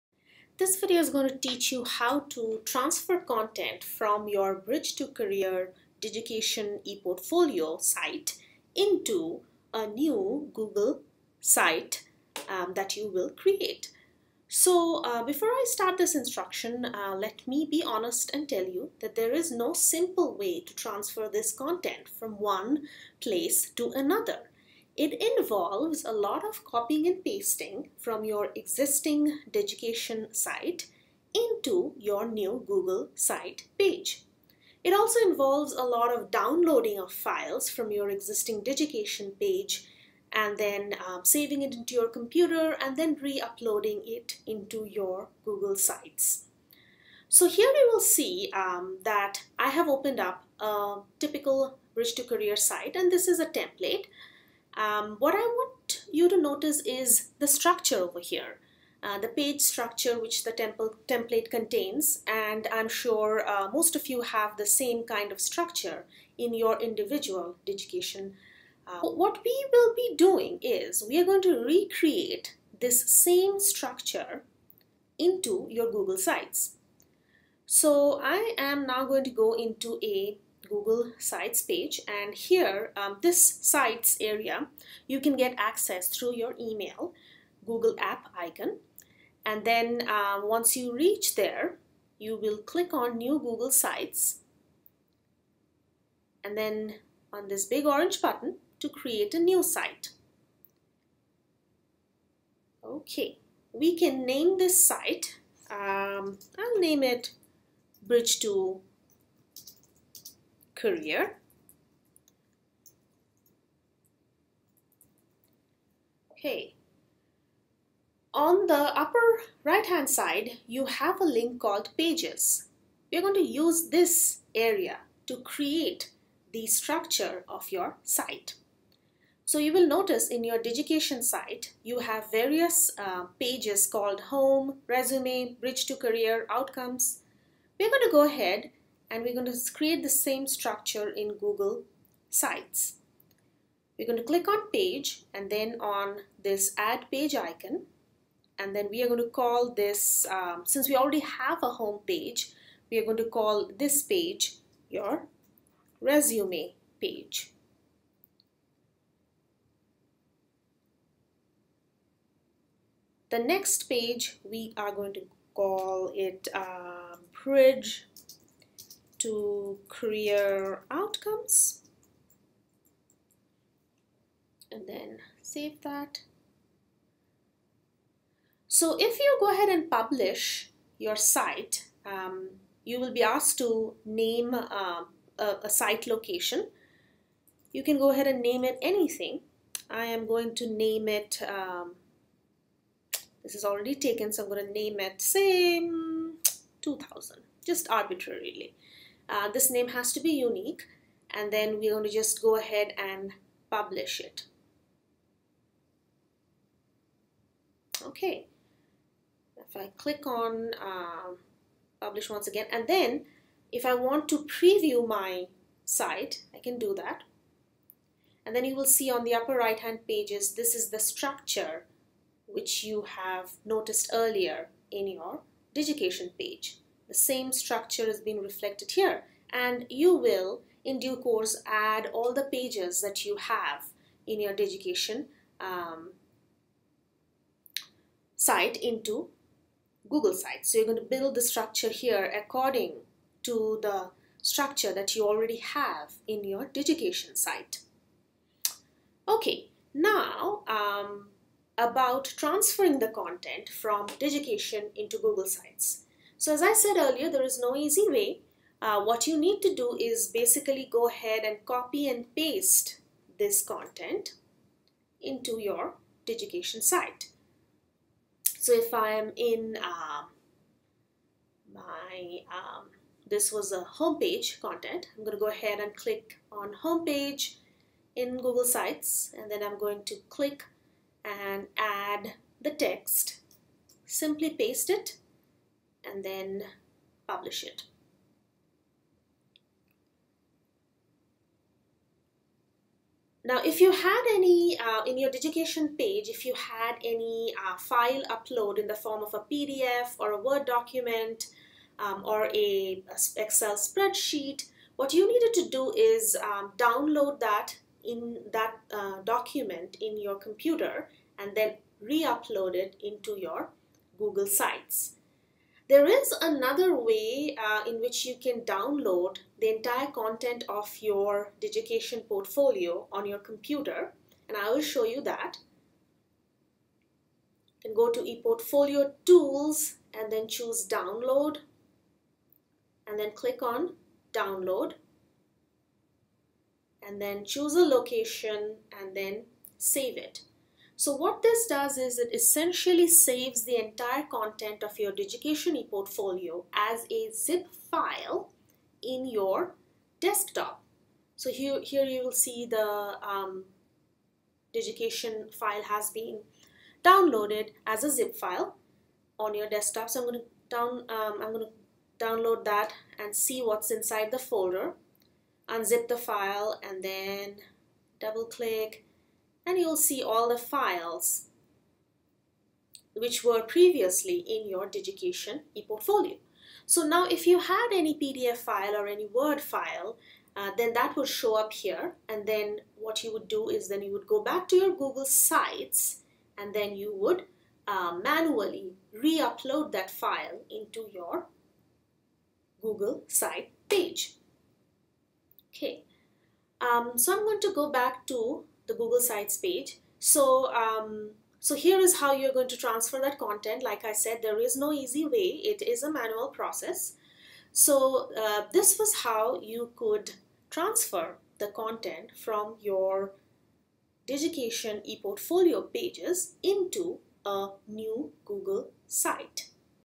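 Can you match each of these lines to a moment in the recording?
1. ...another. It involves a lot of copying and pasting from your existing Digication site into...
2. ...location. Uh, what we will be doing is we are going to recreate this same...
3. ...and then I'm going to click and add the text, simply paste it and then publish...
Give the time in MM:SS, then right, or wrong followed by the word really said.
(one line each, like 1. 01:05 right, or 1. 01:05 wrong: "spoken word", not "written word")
1. 00:23 right
2. 01:07 wrong: "education", not "location"
3. 04:39 right.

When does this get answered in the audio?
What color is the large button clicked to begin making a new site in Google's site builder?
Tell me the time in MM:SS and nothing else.
01:37.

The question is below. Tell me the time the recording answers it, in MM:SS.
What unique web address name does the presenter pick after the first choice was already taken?
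03:15.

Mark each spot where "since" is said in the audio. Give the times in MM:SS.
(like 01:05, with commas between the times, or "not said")
02:30.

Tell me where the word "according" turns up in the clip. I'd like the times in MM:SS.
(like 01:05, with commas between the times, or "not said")
04:02.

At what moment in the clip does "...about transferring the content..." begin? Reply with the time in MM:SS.
04:11.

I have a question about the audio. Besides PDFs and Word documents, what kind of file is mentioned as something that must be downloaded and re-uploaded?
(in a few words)
Excel spreadsheet.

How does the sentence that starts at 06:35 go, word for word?
Okay, um, so I'm going to go back to the Google Sites page.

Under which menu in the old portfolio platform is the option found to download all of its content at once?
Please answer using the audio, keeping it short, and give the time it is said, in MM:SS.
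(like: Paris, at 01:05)
ePortfolio Tools, at 05:28.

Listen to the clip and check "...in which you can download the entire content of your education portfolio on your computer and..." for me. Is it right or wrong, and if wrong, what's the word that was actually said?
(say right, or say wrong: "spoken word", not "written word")
right.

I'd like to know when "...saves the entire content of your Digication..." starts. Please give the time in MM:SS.
05:43.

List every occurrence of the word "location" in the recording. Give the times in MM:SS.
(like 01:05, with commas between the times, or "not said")
03:06, 05:37.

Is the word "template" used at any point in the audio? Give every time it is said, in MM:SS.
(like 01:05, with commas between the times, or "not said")
00:53, 01:01.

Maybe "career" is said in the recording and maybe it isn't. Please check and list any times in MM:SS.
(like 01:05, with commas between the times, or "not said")
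00:05, 00:52, 01:50, 02:15, 02:49.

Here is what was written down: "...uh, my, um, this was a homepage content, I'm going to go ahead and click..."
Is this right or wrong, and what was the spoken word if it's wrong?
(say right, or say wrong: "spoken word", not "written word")
right.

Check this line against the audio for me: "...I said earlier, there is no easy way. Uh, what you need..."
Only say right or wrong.
right.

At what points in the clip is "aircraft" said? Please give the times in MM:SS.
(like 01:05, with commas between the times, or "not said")
not said.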